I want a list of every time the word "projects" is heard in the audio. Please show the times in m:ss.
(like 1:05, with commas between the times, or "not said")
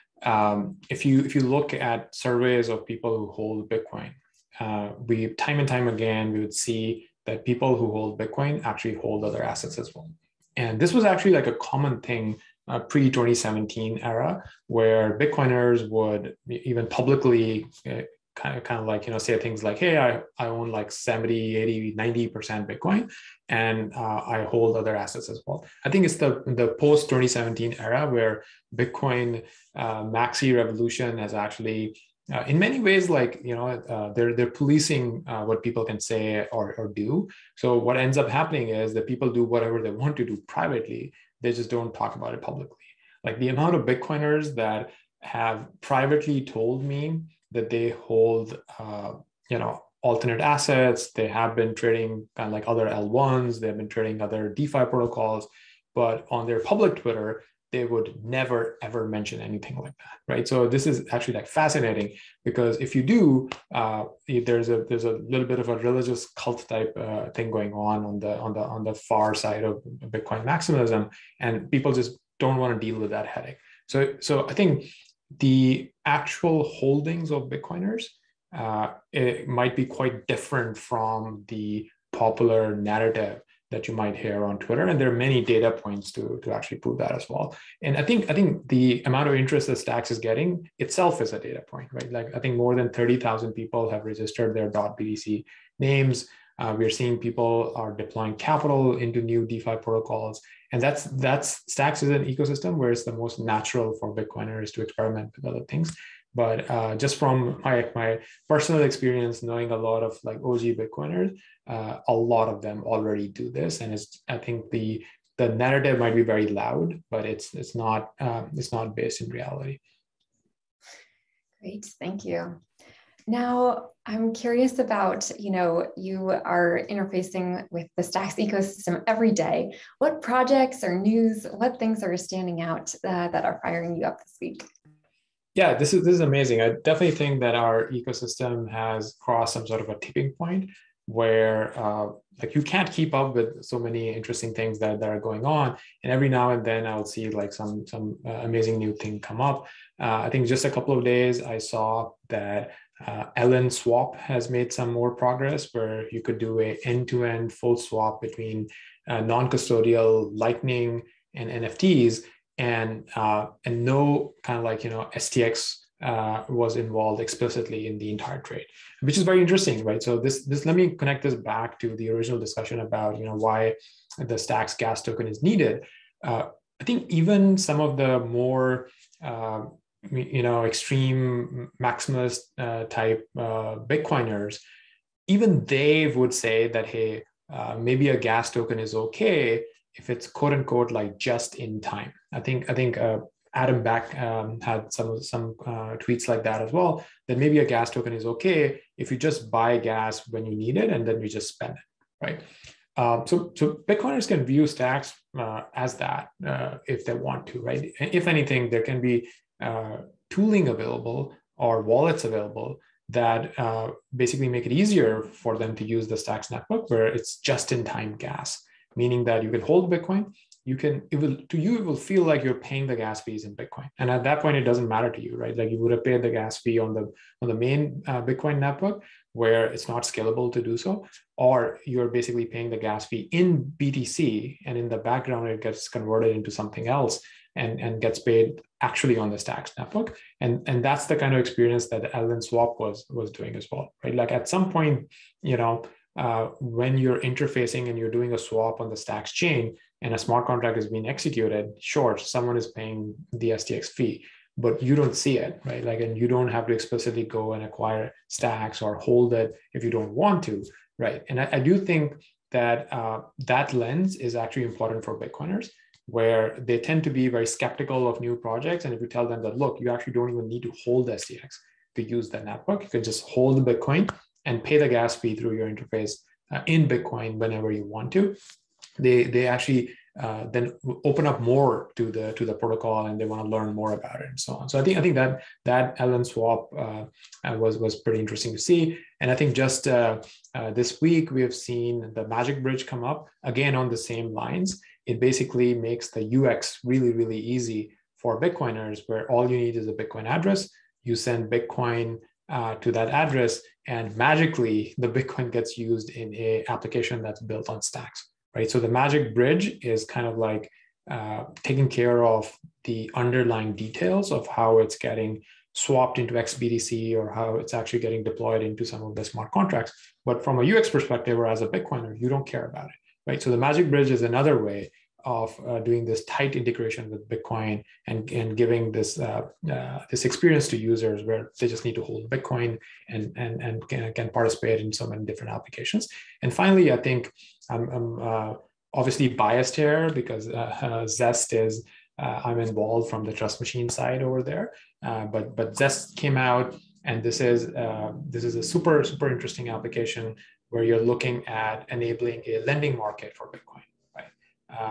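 2:10, 4:28.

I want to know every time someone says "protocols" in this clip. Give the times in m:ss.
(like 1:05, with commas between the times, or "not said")
0:54, 1:39, 4:42.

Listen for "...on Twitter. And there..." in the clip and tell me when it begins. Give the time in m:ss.
1:24.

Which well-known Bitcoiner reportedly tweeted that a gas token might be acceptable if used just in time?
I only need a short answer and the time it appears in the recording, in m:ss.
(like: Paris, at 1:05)
Adam Back, at 3:13.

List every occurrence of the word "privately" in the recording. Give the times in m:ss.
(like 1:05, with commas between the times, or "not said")
0:40, 0:45.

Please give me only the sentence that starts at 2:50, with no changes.
So this this let me connect this back to the original discussion about you know why the Stacks gas token is needed.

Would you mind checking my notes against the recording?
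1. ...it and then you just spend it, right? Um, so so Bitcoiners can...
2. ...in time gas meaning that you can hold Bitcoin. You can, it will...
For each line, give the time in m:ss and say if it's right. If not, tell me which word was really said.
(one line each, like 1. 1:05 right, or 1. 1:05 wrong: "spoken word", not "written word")
1. 3:20 right
2. 3:37 right.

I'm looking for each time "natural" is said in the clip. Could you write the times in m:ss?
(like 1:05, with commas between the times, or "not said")
1:43.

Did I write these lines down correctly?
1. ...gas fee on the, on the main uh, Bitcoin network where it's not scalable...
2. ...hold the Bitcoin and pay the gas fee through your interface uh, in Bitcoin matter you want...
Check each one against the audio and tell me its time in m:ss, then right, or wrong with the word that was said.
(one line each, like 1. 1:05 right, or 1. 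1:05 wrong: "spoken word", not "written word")
1. 3:46 right
2. 4:33 wrong: "whenever", not "matter".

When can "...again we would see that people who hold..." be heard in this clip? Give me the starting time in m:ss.
0:05.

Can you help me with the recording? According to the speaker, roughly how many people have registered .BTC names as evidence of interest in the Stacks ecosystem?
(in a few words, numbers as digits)
30,000.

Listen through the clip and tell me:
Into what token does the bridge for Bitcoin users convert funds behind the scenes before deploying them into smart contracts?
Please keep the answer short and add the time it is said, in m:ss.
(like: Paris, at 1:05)
xBTC, at 5:16.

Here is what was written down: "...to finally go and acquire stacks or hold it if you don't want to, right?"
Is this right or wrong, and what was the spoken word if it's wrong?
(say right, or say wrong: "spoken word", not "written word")
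wrong: "explicitly", not "finally".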